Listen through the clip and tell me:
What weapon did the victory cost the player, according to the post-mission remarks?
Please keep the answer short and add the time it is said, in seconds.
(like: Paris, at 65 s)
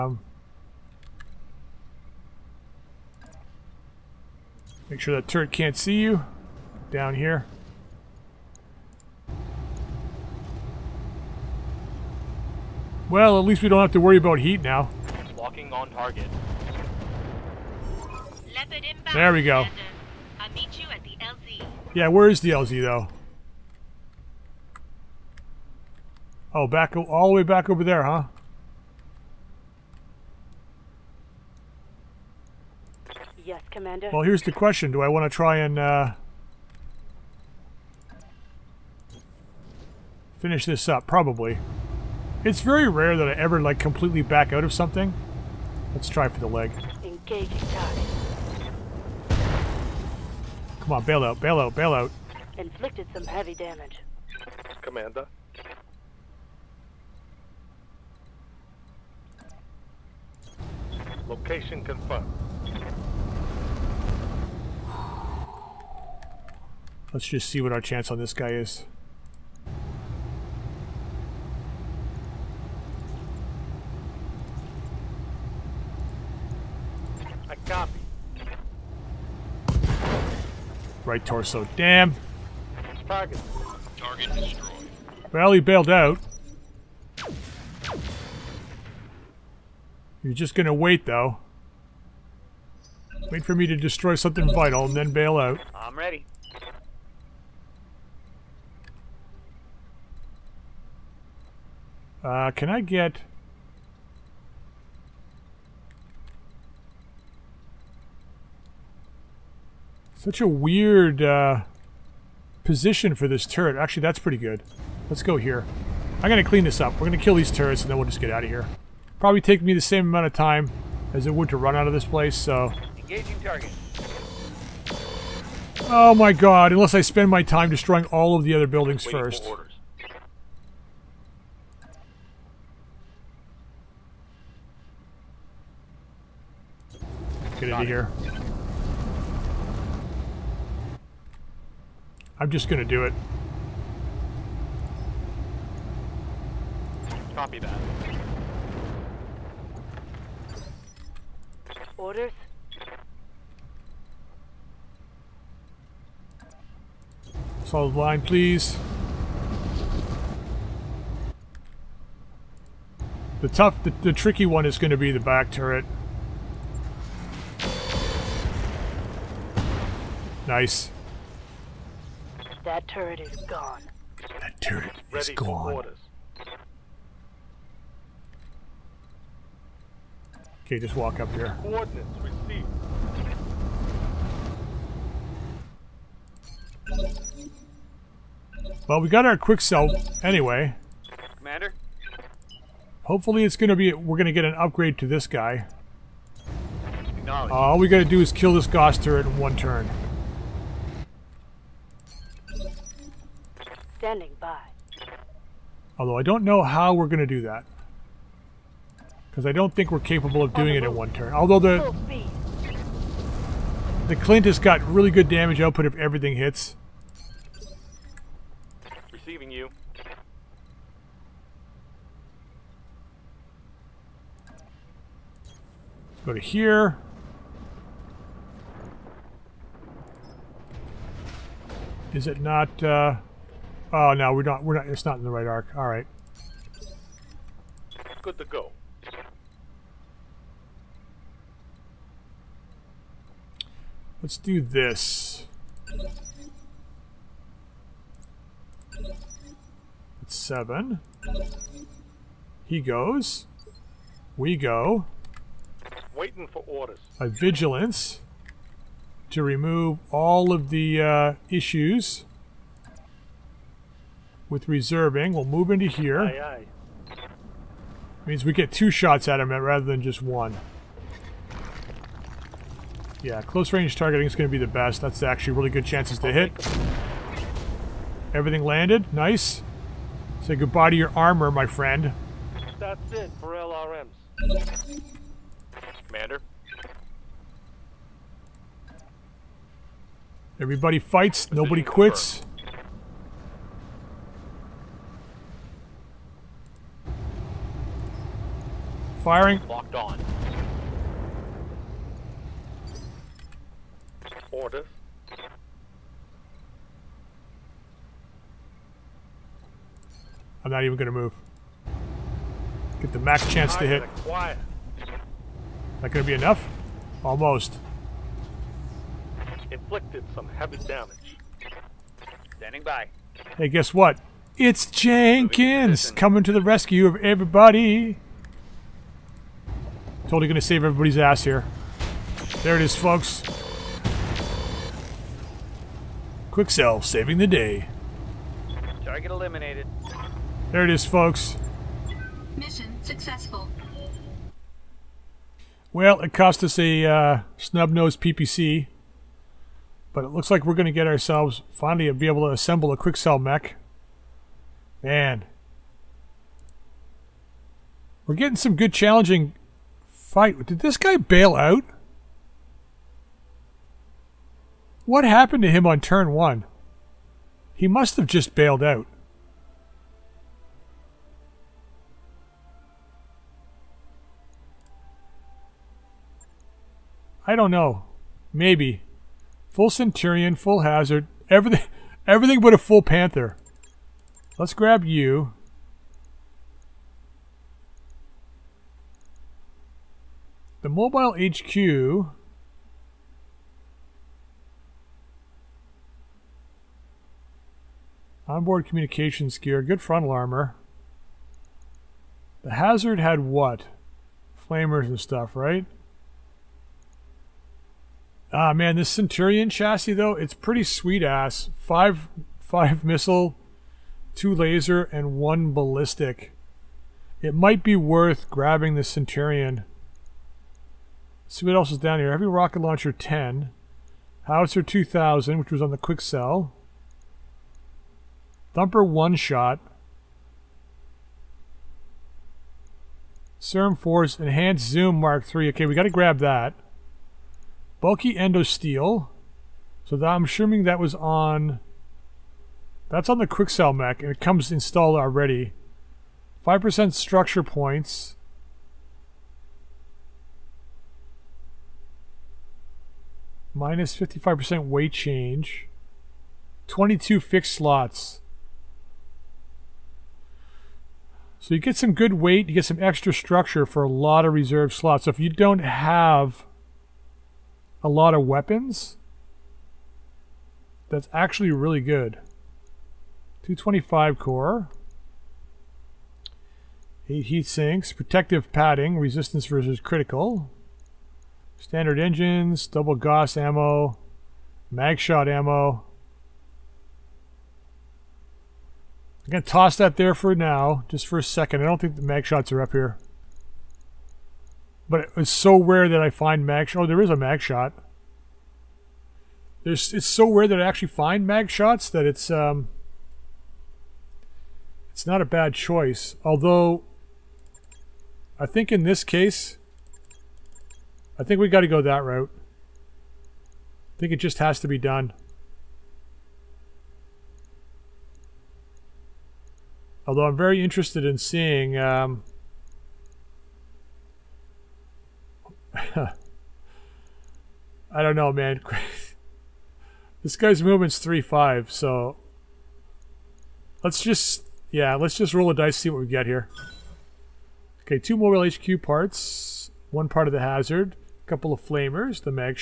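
Snub-nosed PPC, at 347 s.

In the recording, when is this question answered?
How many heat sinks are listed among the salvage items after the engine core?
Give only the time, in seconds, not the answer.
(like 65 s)
477 s.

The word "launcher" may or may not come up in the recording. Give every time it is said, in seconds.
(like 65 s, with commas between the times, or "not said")
422 s.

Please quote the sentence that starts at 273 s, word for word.
Yeah, close range targeting is going to be the best.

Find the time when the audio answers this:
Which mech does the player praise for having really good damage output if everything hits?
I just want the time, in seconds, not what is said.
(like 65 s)
214 s.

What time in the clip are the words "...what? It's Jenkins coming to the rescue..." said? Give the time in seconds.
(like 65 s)
323 s.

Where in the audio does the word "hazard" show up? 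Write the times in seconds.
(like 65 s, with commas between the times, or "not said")
380 s, 402 s, 540 s.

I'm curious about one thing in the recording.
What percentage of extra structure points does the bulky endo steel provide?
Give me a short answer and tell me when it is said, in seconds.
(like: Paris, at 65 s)
5%, at 446 s.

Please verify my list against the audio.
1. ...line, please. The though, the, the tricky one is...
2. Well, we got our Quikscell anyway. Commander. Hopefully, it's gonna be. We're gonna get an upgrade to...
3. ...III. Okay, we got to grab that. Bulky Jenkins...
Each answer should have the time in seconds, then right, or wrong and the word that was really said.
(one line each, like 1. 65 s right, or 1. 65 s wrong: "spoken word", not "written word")
1. 157 s wrong: "tough", not "though"
2. 188 s right
3. 435 s wrong: "Endo", not "Jenkins".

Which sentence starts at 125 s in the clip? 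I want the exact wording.
Oh my god, unless I spend my time destroying all of the other buildings first.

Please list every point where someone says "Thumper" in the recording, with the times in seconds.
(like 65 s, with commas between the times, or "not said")
428 s.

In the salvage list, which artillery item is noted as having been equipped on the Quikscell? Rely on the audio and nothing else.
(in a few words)
Howitzer 2000.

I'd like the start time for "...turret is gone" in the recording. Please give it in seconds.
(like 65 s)
172 s.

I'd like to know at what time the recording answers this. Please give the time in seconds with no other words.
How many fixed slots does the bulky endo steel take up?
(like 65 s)
456 s.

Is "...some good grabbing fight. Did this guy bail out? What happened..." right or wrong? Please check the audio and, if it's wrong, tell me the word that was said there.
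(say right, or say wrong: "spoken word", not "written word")
wrong: "challenging", not "grabbing".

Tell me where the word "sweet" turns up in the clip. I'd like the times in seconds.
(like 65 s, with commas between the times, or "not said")
410 s.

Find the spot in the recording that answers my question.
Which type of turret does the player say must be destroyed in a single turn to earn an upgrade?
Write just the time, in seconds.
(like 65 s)
198 s.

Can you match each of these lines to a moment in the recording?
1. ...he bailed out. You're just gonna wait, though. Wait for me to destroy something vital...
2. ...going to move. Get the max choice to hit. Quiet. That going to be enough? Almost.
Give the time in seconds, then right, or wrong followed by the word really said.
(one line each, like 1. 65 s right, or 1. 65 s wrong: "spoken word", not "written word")
1. 85 s right
2. 310 s wrong: "chance", not "choice".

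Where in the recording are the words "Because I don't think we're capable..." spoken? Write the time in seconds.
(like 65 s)
209 s.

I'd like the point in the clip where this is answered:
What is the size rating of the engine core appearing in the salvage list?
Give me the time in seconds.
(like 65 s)
473 s.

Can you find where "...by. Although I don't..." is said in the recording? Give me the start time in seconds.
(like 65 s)
204 s.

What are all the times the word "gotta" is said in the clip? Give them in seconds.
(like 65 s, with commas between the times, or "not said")
197 s.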